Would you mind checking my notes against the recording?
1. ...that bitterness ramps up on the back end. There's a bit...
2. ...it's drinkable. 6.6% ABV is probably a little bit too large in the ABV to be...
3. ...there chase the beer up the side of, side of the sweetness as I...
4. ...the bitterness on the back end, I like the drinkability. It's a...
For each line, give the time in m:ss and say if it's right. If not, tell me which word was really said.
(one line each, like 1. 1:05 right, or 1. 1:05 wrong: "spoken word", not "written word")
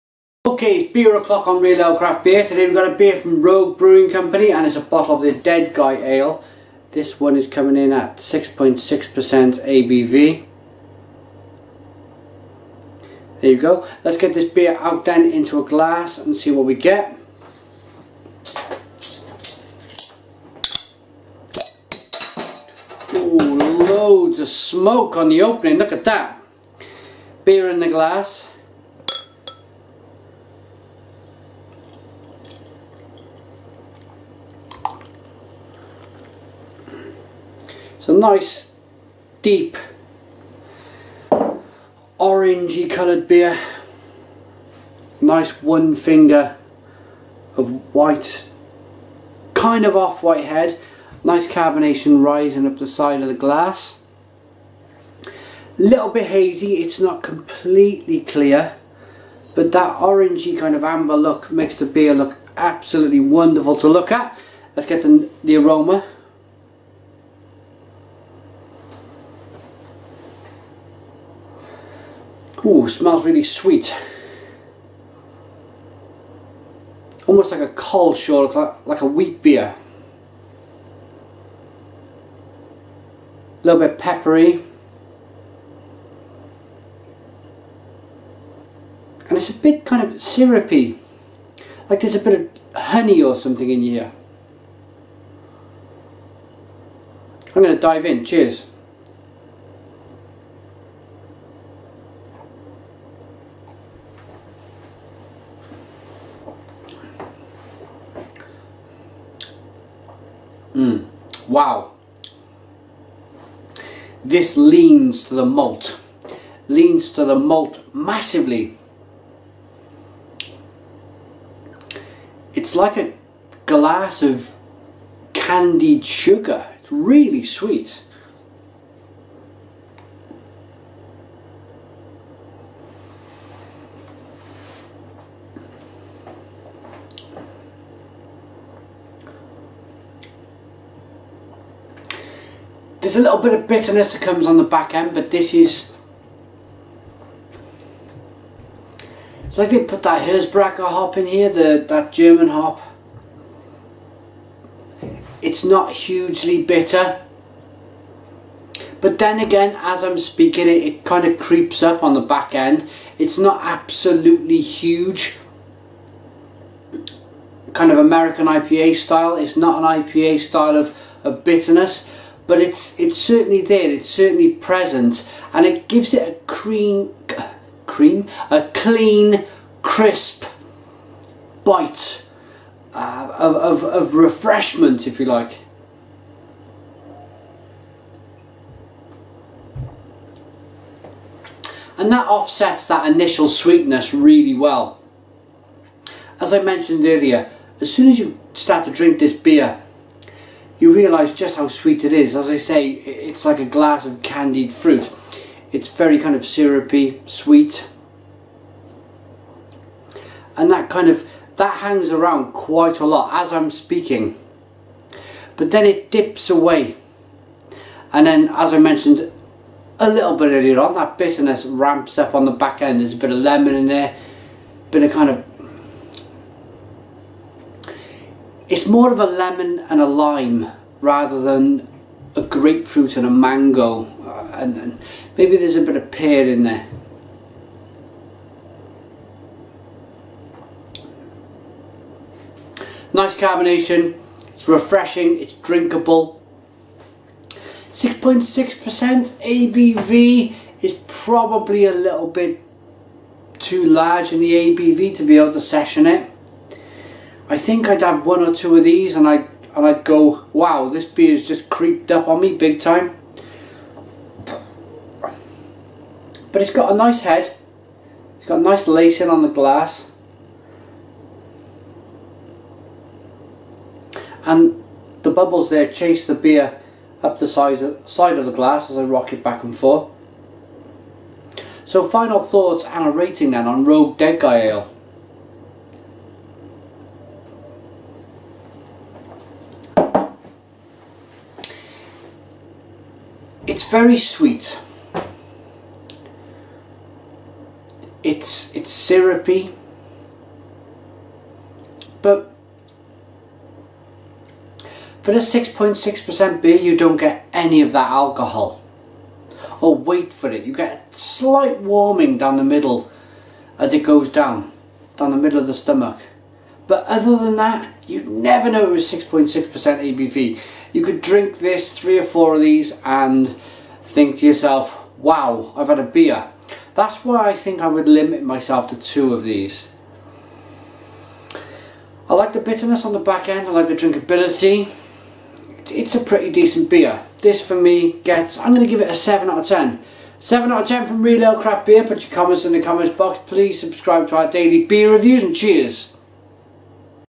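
1. 3:40 right
2. 4:05 right
3. 4:35 wrong: "glass", not "sweetness"
4. 5:32 right.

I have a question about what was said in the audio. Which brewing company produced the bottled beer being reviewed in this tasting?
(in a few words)
Rogue Brewing Company.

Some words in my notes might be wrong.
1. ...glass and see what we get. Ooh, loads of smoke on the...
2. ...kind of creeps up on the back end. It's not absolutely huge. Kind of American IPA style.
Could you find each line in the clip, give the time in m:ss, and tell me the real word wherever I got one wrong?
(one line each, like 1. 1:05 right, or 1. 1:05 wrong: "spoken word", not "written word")
1. 0:15 right
2. 2:41 right.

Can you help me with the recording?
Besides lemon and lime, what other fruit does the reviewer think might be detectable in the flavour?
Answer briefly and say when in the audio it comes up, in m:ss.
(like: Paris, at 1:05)
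pear, at 3:56.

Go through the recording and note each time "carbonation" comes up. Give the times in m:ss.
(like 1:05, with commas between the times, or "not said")
0:51, 4:03.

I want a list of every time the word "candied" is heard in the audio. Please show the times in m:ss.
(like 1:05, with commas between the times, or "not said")
2:05, 3:24.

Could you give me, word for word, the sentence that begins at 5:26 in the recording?
That's why I think I would limit myself to two of these.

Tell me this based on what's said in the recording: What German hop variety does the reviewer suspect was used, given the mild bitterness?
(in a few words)
Hersbrucker.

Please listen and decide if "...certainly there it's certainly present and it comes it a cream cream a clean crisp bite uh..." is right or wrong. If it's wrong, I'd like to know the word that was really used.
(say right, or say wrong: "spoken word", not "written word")
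wrong: "gives", not "comes".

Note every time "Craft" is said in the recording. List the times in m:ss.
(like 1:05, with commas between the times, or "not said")
0:01, 5:41.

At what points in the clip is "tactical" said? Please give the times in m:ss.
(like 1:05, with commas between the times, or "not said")
not said.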